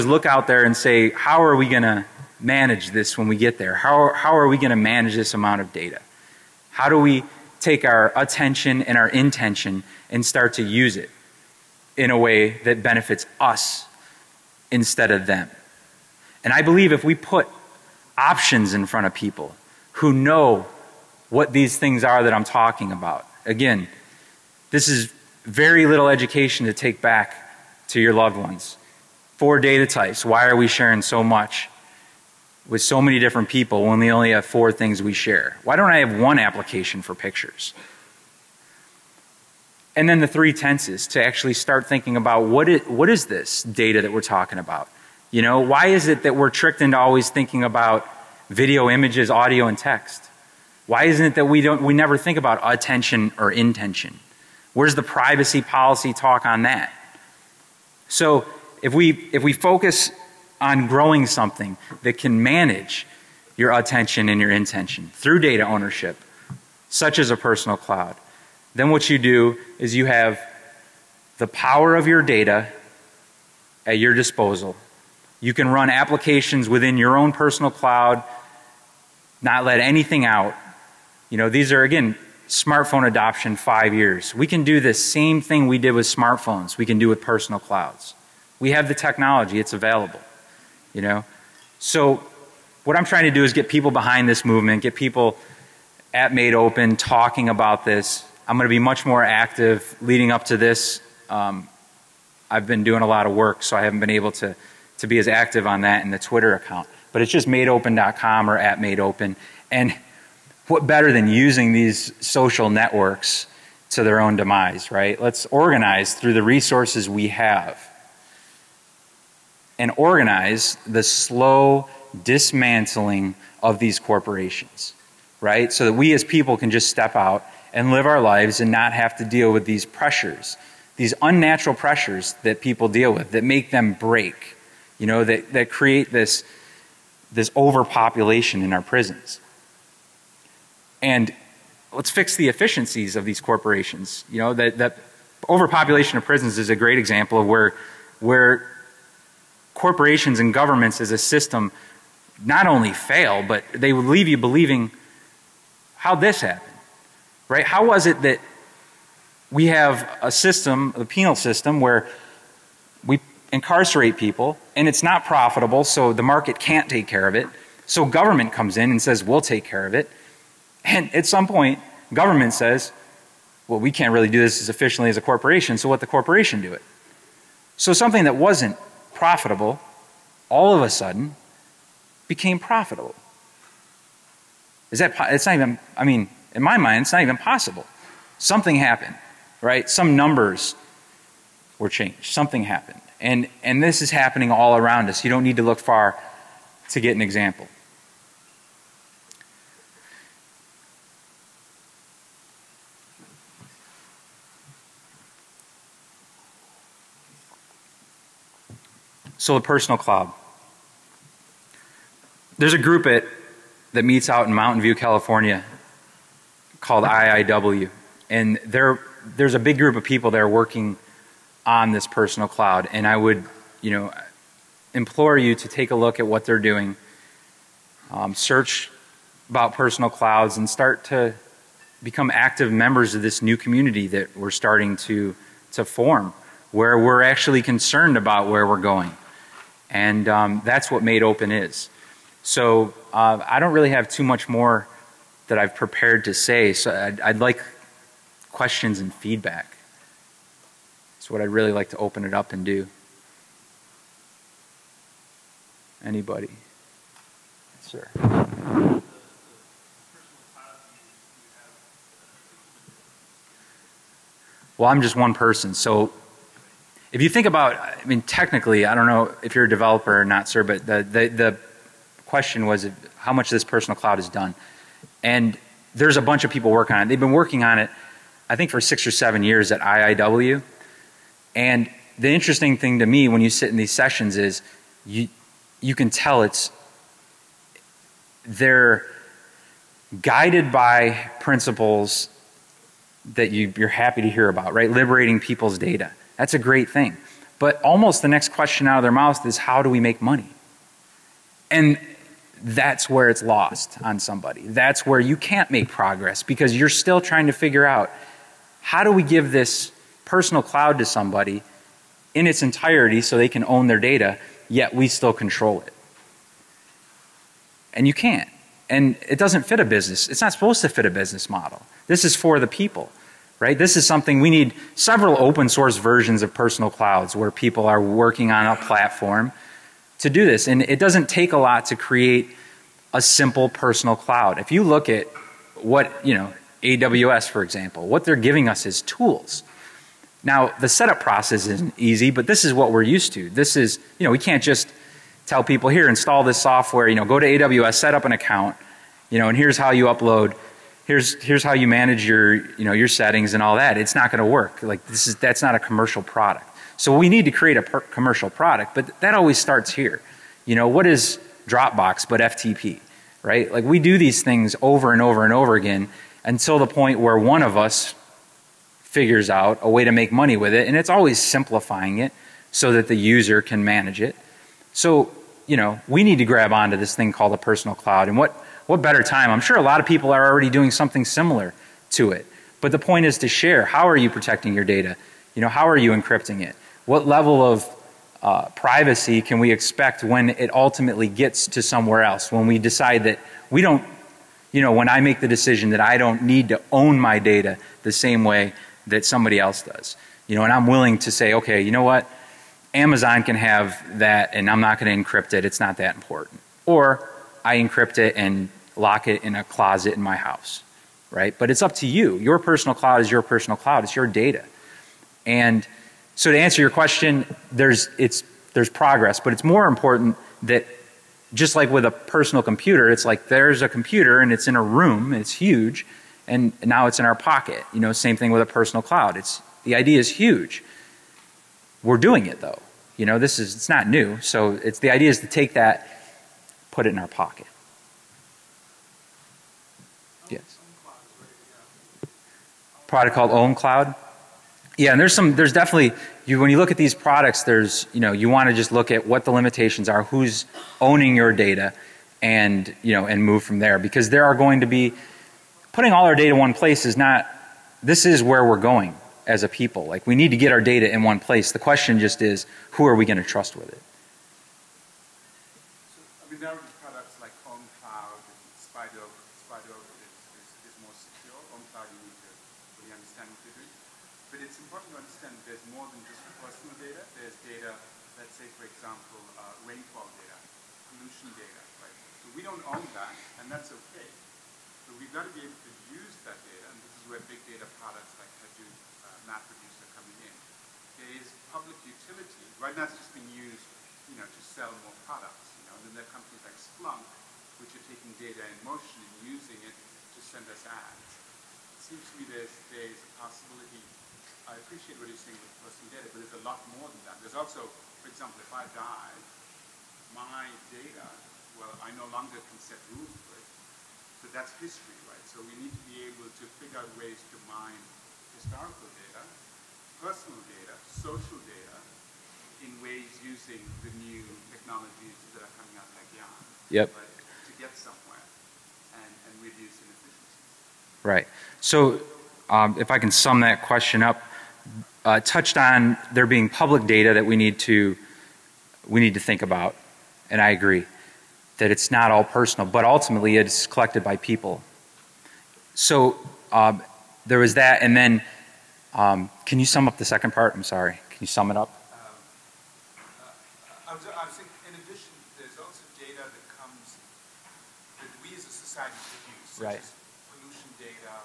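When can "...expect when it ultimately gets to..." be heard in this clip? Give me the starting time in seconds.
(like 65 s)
389 s.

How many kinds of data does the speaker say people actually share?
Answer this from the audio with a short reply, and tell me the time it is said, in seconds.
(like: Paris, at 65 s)
4, at 29 s.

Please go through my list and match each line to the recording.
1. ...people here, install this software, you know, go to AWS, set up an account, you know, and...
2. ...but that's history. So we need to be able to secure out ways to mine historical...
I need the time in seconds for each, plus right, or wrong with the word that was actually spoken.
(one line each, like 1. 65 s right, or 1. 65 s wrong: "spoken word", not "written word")
1. 345 s right
2. 514 s wrong: "figure", not "secure".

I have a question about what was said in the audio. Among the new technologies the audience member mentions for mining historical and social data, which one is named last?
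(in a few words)
YARN.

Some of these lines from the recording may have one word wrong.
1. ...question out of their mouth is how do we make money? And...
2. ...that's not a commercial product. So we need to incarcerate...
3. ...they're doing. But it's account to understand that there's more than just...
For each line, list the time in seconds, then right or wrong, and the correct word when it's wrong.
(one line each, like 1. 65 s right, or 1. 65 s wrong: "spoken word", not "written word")
1. 298 s right
2. 355 s wrong: "create", not "incarcerate"
3. 473 s wrong: "important", not "account".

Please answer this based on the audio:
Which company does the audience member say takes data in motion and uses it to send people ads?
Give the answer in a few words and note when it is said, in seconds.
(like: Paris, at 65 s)
Splunk, at 496 s.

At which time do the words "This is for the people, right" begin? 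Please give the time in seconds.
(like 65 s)
322 s.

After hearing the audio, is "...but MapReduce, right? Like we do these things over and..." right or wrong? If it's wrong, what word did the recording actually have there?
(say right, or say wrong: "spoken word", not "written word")
wrong: "FTP", not "MapReduce".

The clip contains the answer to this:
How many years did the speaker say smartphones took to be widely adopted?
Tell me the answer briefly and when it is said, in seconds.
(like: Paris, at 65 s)
5, at 83 s.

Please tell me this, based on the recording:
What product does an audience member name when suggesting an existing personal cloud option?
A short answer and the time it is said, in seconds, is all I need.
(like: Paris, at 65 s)
ownCloud, at 443 s.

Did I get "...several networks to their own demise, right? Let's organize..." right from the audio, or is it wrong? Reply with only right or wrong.
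wrong.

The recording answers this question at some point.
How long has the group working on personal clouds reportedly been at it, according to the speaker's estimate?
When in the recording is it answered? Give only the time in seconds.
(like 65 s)
278 s.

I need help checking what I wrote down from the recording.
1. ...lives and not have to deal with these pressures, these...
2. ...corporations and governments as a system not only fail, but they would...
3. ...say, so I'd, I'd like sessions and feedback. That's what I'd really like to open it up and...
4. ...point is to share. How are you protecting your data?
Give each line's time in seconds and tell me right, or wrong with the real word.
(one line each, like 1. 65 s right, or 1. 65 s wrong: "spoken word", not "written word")
1. 128 s right
2. 149 s right
3. 246 s wrong: "questions", not "sessions"
4. 382 s right.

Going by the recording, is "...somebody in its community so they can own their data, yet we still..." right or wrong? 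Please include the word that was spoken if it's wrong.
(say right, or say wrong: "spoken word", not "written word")
wrong: "entirety", not "community".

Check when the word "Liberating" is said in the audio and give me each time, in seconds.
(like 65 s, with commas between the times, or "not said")
294 s.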